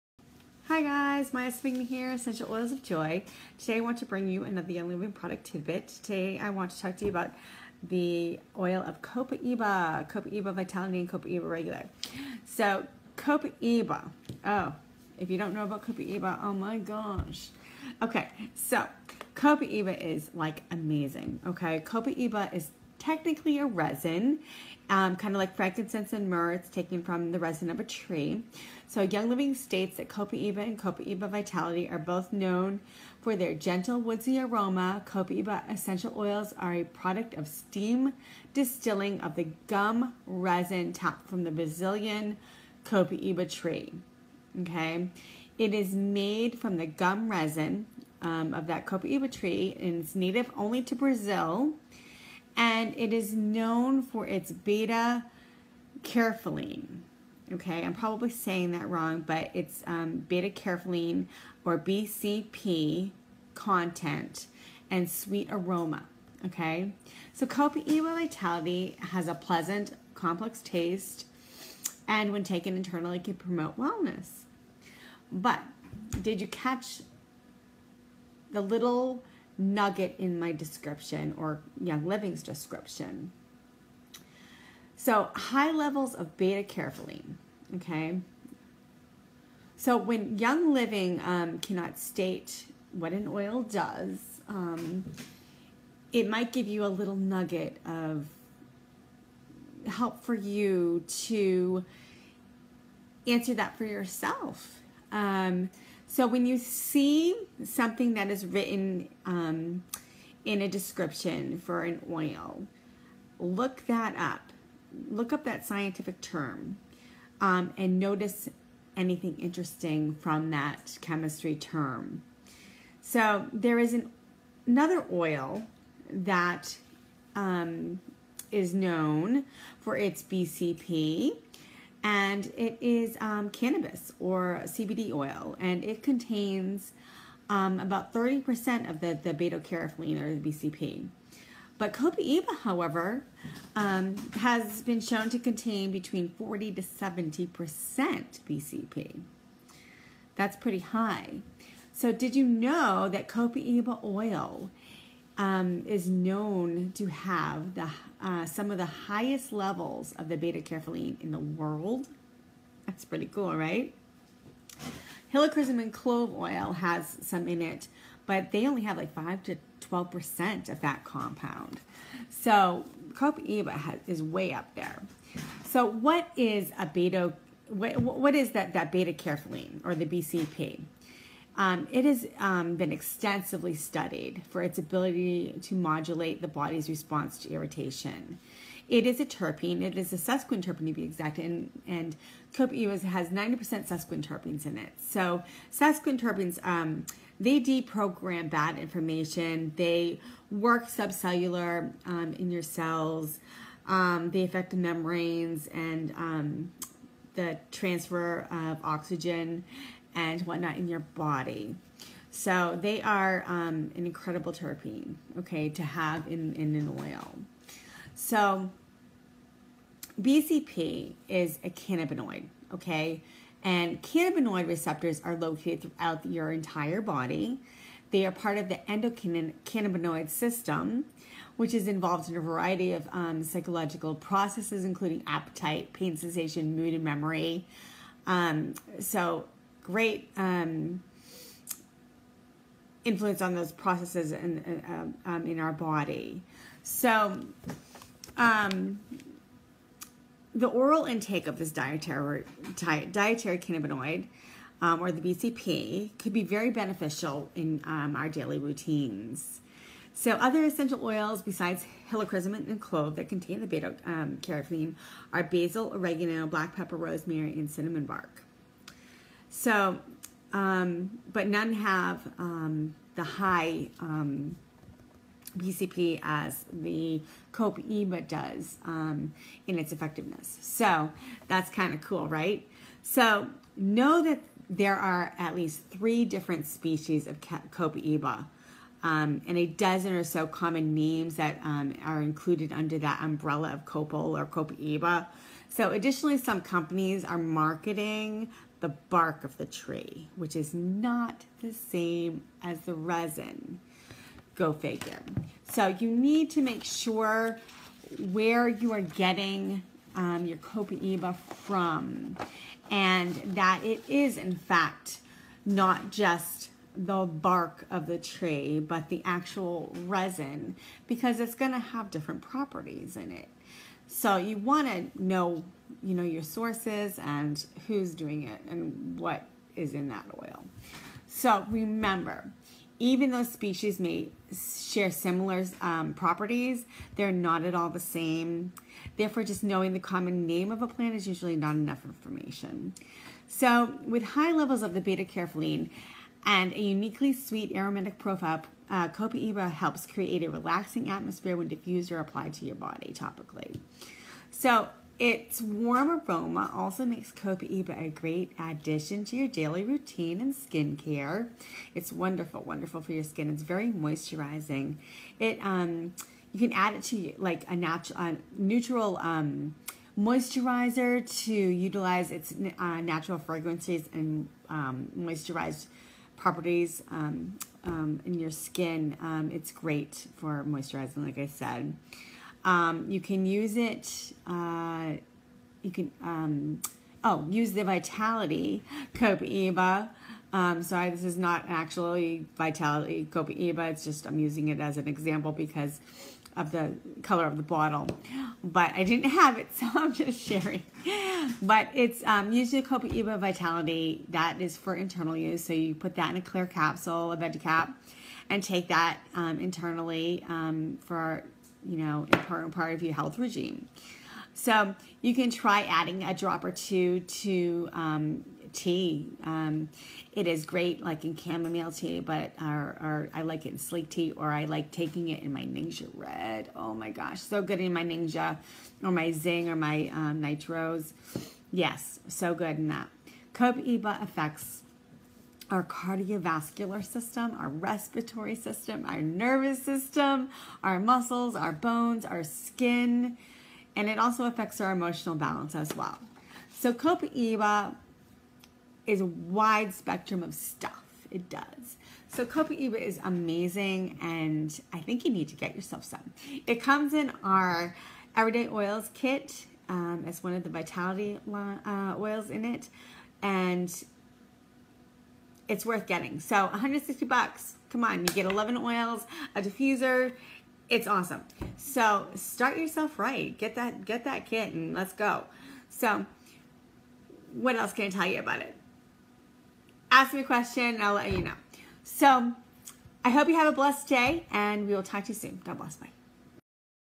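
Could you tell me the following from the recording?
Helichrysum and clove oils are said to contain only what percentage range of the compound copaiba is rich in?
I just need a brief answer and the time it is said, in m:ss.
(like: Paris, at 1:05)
5 to 12%, at 2:49.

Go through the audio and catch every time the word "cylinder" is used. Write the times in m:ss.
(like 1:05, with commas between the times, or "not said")
not said.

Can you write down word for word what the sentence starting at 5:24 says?
So you want to know, you know, your sources and who's doing it and what is in that oil.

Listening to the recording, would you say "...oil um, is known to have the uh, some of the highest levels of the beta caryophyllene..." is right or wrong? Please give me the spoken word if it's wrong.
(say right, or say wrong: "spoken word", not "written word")
right.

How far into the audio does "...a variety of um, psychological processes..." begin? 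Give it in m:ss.
3:52.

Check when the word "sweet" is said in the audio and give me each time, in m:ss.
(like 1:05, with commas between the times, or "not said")
1:05, 5:47.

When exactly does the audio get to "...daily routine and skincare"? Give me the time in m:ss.
5:59.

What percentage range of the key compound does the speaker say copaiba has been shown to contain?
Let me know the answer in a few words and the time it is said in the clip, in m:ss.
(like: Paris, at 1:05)
40 to 70%, at 2:26.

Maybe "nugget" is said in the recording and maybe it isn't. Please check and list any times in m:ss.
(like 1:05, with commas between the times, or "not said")
1:19, 1:37.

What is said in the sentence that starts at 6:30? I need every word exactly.
Um, so I, this is not actually Vitality Copaiba.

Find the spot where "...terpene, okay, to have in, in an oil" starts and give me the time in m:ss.
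3:34.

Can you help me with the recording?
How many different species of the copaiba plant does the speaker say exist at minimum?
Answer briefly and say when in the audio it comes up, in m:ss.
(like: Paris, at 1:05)
3, at 4:45.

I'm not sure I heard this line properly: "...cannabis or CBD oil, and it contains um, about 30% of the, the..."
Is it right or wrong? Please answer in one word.
right.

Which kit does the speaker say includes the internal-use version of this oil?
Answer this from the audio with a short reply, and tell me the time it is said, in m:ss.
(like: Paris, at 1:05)
Everyday Oils kit, at 7:38.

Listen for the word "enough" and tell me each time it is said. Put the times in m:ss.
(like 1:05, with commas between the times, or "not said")
5:41.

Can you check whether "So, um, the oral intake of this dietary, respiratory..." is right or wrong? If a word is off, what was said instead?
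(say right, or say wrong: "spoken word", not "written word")
wrong: "dietary", not "respiratory".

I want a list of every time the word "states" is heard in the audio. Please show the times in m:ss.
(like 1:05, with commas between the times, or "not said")
0:29, 1:31.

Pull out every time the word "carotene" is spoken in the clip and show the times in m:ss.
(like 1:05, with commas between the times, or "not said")
1:26, 2:19, 4:23, 5:45.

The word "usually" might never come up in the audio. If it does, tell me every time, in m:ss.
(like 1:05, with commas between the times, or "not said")
5:41, 6:42.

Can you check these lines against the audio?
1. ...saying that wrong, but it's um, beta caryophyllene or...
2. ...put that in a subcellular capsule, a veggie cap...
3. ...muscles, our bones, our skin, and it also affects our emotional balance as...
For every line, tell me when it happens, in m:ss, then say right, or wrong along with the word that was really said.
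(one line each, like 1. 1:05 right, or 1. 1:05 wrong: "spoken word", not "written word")
1. 0:58 right
2. 6:45 wrong: "clear", not "subcellular"
3. 7:20 right.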